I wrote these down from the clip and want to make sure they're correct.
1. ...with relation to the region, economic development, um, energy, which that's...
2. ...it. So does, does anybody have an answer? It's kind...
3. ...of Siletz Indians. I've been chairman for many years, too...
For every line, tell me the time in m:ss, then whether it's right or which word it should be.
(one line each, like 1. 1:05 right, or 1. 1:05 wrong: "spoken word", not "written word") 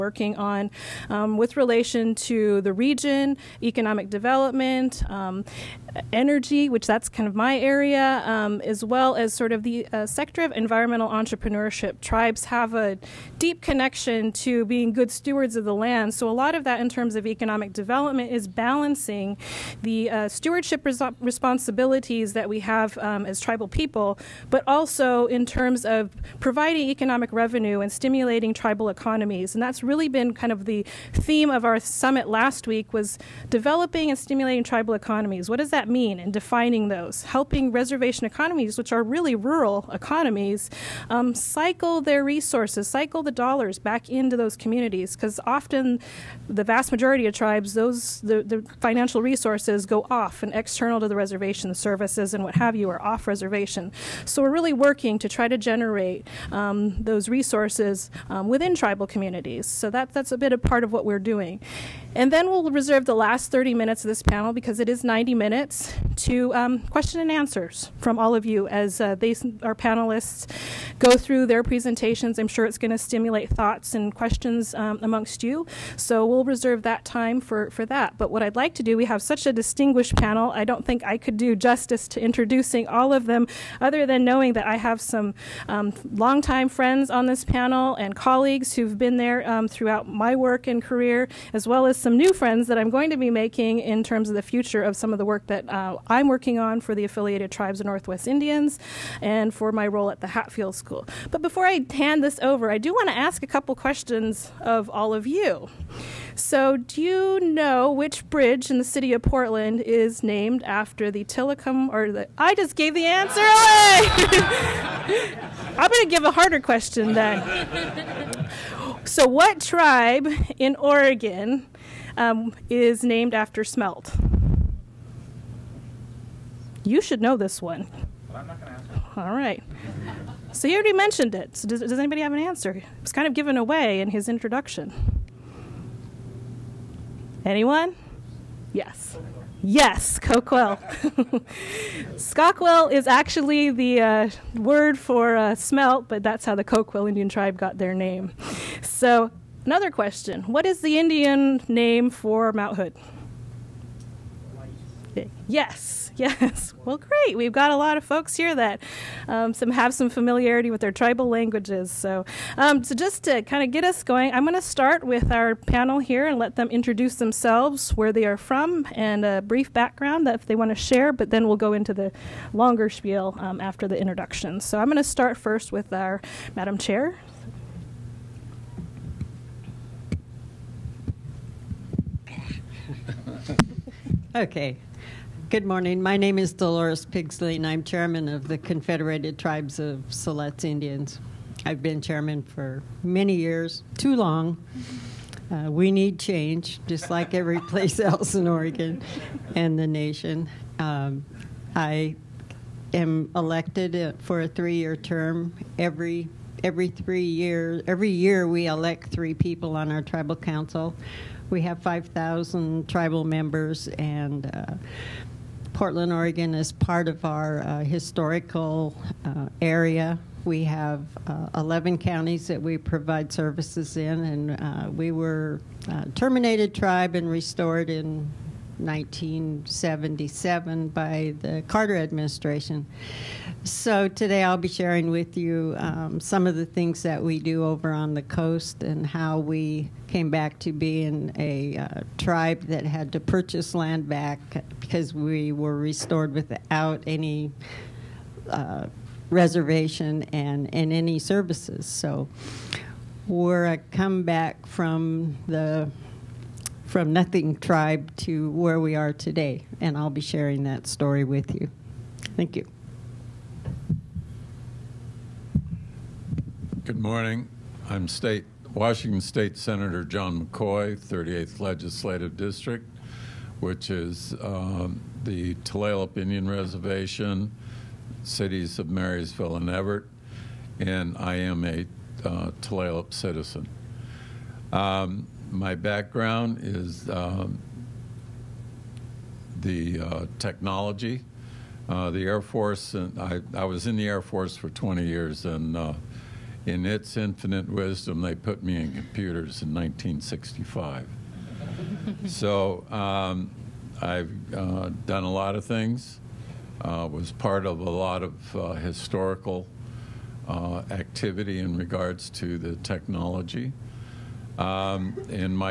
1. 0:01 right
2. 2:11 right
3. 3:09 right.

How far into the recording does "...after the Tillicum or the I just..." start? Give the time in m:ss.
1:50.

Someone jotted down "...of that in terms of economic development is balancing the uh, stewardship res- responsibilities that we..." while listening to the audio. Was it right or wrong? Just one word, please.
right.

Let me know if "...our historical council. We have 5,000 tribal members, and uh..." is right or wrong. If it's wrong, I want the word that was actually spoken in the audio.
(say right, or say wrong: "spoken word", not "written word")
wrong: "tribal", not "historical".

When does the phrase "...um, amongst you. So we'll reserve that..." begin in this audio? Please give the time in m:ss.
1:14.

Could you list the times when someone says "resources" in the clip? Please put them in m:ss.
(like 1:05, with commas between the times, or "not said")
0:42, 0:49, 0:57.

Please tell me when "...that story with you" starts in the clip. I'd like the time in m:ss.
4:20.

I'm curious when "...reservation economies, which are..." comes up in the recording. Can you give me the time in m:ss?
0:37.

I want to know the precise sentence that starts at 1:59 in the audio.
so, what tribe in Oregon um, is named after smelt.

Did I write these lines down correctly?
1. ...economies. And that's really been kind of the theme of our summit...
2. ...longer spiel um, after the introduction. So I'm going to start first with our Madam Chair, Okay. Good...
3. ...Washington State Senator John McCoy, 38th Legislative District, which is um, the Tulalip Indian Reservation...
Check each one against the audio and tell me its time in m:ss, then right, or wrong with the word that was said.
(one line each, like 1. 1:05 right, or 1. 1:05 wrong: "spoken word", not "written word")
1. 0:28 right
2. 2:52 right
3. 4:28 right.